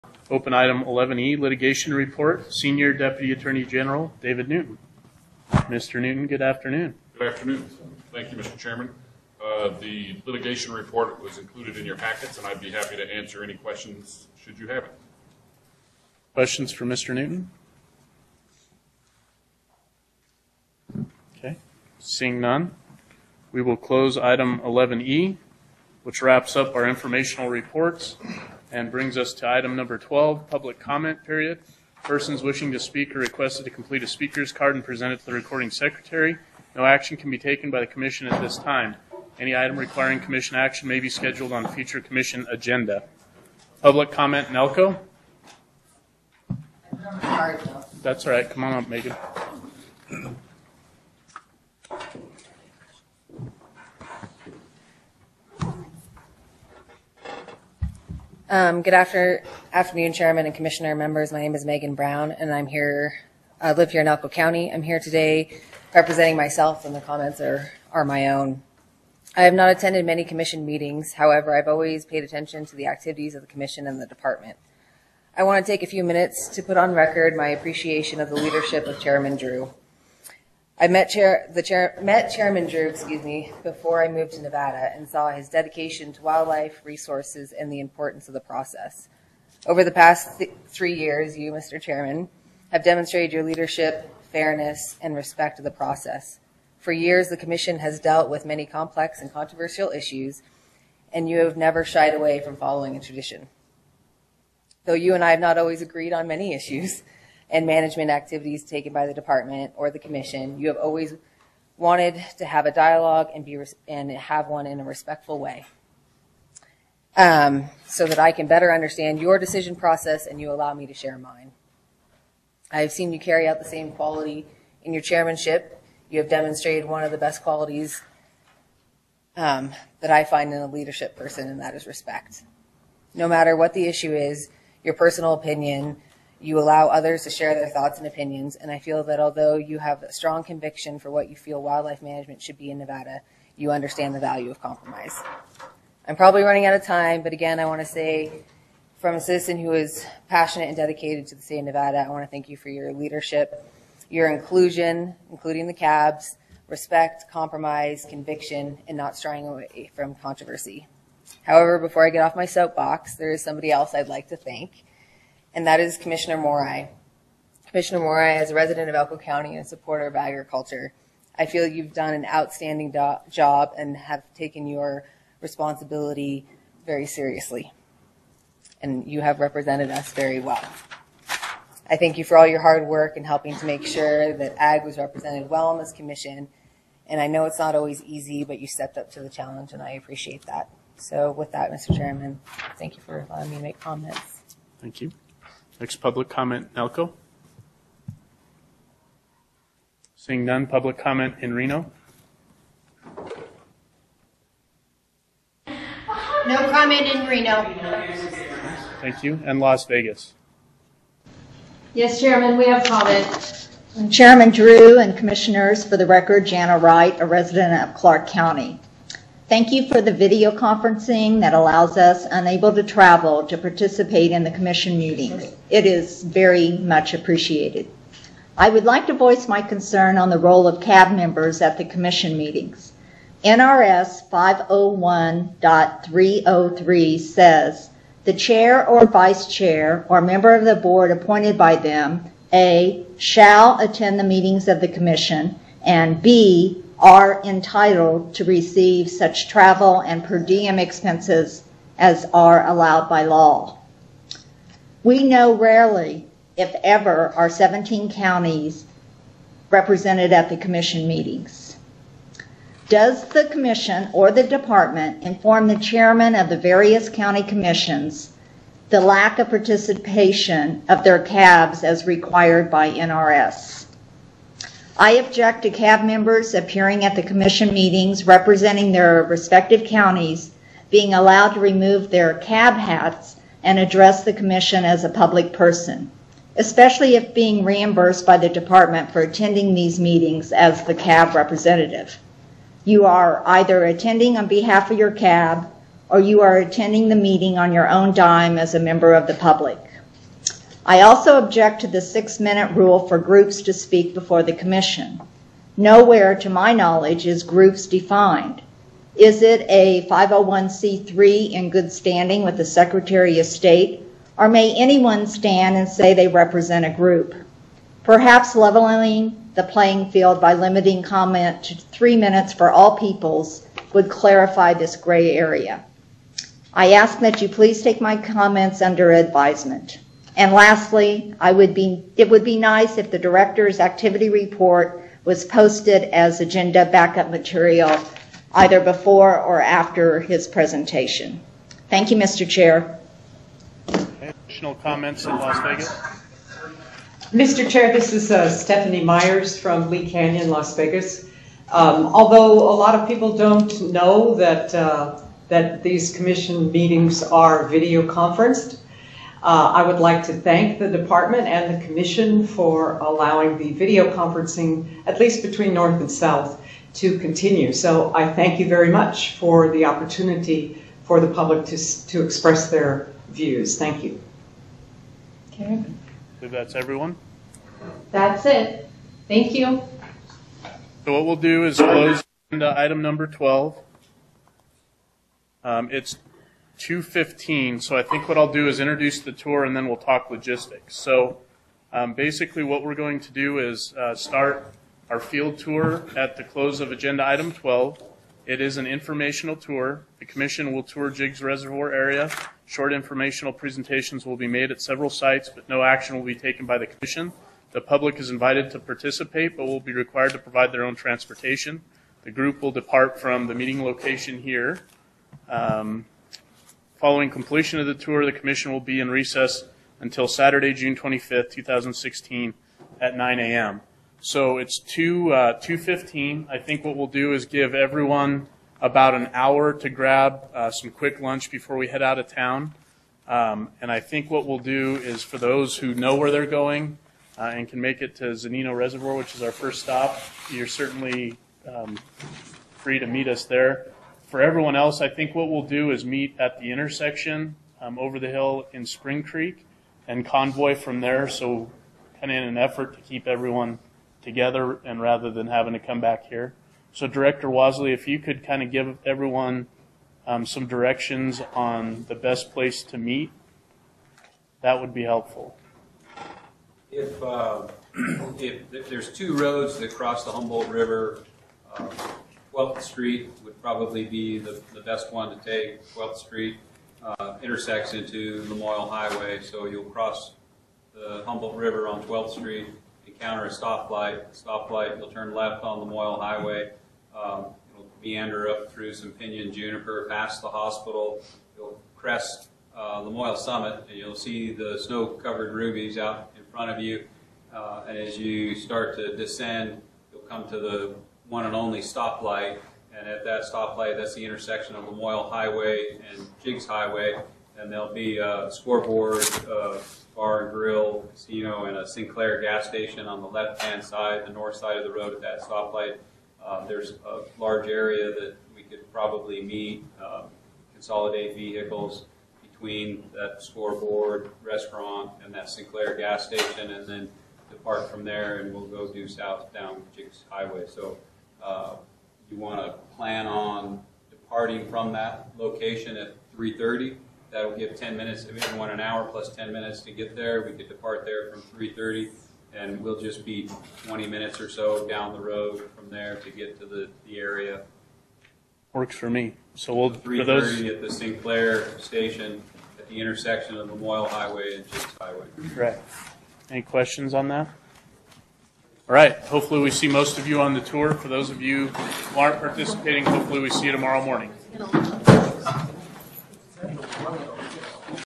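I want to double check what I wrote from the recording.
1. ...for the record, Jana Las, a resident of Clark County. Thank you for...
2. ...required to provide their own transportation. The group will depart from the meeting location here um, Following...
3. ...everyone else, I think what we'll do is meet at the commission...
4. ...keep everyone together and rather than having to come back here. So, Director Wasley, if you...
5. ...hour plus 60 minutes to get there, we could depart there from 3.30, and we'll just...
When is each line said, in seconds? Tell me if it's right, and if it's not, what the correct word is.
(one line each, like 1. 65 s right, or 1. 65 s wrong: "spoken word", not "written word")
1. 215 s wrong: "Wright", not "Las"
2. 409 s right
3. 444 s wrong: "intersection", not "commission"
4. 453 s right
5. 538 s wrong: "10", not "60".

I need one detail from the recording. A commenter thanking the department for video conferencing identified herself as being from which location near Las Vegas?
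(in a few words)
Lee Canyon.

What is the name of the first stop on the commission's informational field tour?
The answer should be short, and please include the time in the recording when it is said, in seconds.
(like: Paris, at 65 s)
Zunino Reservoir, at 438 s.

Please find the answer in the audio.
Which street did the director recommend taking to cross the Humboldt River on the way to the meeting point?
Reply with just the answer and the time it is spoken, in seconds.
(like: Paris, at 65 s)
12th Street, at 475 s.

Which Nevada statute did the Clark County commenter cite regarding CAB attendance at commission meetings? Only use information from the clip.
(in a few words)
NRS 501.303.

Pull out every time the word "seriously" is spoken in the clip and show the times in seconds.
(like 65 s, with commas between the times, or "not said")
177 s.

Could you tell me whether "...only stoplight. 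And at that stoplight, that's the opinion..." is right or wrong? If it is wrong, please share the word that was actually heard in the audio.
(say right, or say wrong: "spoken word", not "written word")
wrong: "intersection", not "opinion".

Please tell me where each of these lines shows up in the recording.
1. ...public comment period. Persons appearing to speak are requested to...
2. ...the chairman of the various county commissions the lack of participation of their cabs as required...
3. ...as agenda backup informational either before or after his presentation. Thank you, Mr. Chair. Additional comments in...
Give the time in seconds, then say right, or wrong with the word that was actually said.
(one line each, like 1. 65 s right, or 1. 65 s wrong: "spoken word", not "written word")
1. 30 s wrong: "wishing", not "appearing"
2. 265 s right
3. 336 s wrong: "material", not "informational".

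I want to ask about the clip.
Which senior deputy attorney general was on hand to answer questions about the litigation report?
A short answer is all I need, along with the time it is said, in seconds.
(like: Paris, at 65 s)
David Newton, at 4 s.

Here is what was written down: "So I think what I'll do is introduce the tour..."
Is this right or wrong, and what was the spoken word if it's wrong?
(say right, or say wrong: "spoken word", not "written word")
right.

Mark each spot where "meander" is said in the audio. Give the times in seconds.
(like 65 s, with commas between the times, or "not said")
488 s.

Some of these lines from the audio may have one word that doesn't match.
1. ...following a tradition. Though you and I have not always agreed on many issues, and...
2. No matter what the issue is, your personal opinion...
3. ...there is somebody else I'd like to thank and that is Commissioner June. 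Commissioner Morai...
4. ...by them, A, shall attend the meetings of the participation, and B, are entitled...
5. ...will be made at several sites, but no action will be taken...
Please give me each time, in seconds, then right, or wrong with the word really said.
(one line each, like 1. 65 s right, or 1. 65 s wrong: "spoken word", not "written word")
1. 102 s right
2. 133 s right
3. 163 s wrong: "Morai", not "June"
4. 241 s wrong: "commission", not "participation"
5. 404 s right.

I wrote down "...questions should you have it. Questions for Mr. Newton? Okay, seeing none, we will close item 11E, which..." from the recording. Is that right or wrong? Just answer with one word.
right.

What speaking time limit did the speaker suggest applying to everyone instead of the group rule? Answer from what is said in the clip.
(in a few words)
three minutes.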